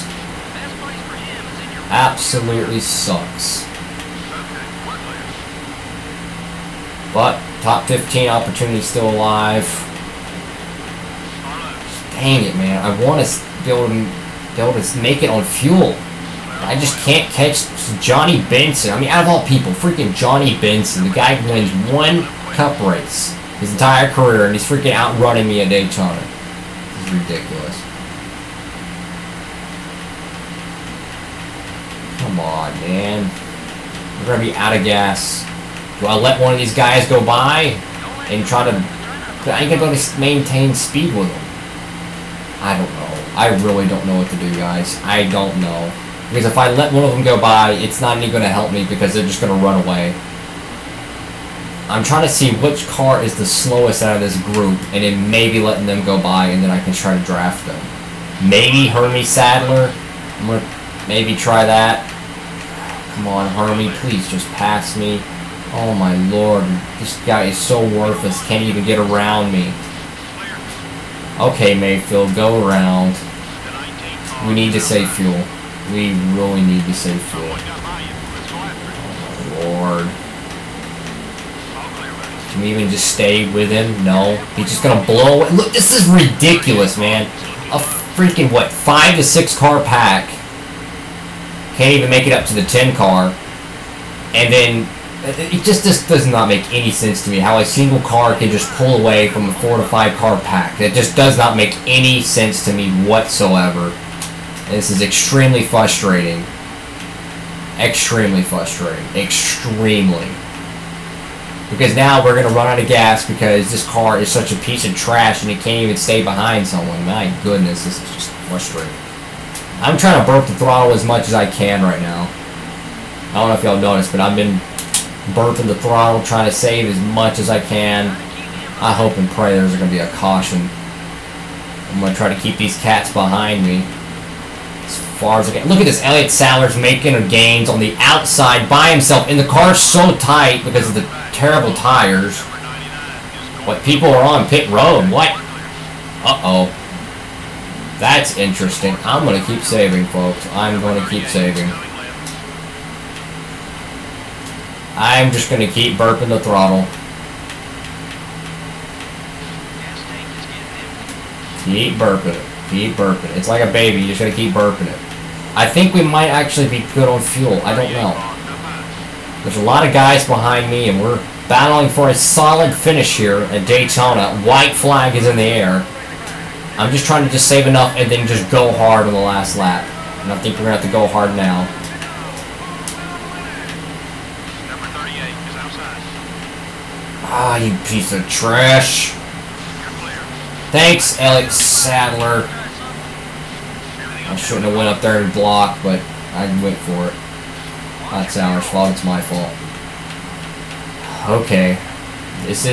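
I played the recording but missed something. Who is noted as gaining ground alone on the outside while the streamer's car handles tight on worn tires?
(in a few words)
Elliott Sadler.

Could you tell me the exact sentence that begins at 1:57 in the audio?
My goodness, this is just frustrating.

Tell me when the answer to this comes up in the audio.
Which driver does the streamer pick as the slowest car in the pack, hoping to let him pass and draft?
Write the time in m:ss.
0:58.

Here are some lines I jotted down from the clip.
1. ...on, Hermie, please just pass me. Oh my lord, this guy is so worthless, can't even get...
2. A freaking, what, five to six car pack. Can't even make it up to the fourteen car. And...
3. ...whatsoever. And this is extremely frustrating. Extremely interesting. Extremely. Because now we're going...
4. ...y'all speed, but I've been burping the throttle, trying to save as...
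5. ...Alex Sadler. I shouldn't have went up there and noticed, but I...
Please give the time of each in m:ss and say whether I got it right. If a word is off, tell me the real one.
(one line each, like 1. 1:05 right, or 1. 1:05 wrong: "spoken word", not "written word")
1. 1:03 right
2. 1:27 wrong: "ten", not "fourteen"
3. 1:43 wrong: "frustrating", not "interesting"
4. 2:03 wrong: "noticed", not "speed"
5. 3:11 wrong: "blocked", not "noticed".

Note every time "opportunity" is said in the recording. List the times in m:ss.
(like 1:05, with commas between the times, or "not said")
0:08.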